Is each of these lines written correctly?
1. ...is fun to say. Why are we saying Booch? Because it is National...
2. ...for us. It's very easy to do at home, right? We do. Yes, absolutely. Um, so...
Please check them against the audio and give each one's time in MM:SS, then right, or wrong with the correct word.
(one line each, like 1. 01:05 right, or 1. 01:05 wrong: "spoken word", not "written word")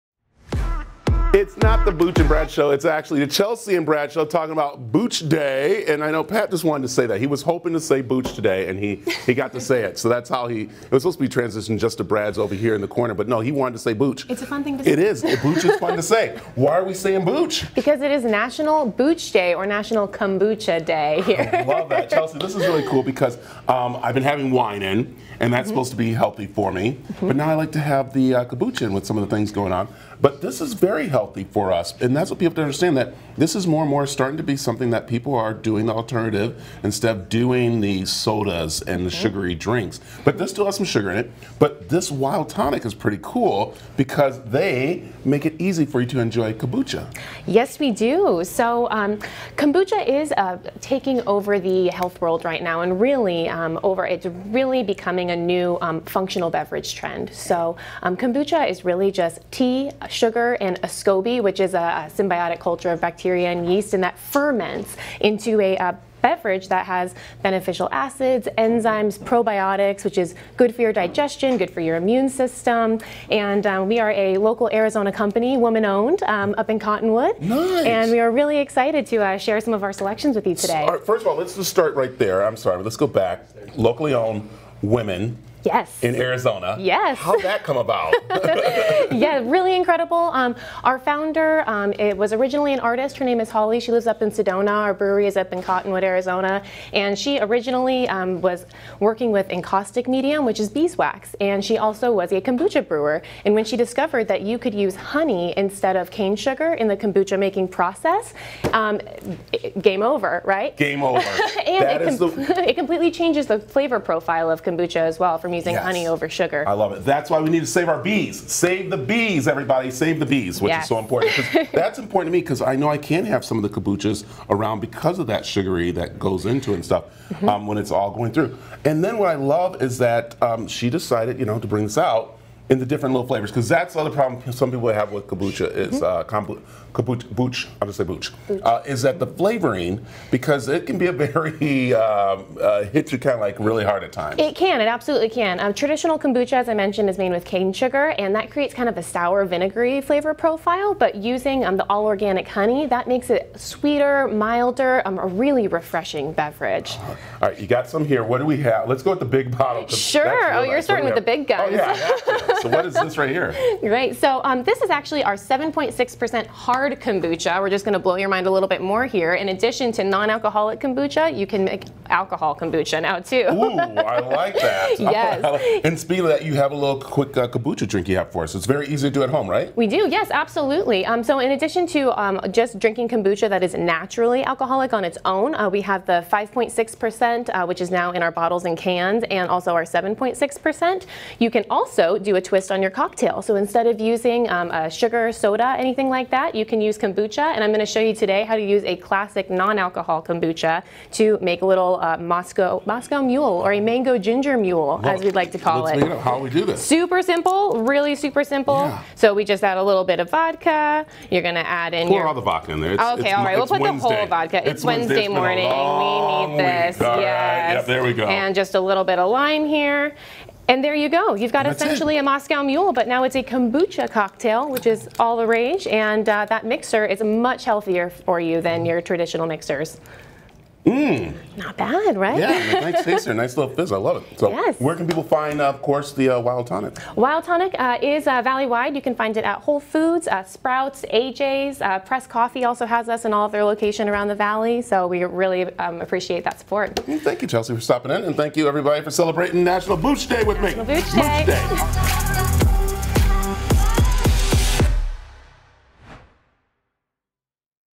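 1. 00:15 right
2. 02:58 right.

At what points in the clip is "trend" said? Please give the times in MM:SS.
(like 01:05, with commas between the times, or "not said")
00:56.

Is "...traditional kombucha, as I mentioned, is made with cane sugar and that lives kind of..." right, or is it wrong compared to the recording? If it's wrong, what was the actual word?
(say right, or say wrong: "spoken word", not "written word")
wrong: "creates", not "lives".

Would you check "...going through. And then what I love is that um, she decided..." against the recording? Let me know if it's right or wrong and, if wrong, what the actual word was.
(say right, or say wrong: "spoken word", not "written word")
right.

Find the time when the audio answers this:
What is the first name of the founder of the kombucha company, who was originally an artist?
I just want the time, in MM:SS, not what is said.
01:33.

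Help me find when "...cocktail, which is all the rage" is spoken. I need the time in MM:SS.
03:44.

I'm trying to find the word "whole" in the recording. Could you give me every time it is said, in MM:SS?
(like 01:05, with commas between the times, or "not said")
03:34, 03:59.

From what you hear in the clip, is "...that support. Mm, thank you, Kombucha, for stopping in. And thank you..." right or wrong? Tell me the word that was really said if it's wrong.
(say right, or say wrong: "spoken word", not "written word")
wrong: "Chelsea", not "Kombucha".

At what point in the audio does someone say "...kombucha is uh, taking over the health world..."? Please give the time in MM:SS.
00:49.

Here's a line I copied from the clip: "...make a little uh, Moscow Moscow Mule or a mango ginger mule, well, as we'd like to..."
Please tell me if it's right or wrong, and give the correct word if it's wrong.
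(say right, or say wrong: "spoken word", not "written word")
right.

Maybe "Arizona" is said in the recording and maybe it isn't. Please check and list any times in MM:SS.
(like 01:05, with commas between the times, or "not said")
01:14, 01:26, 01:36.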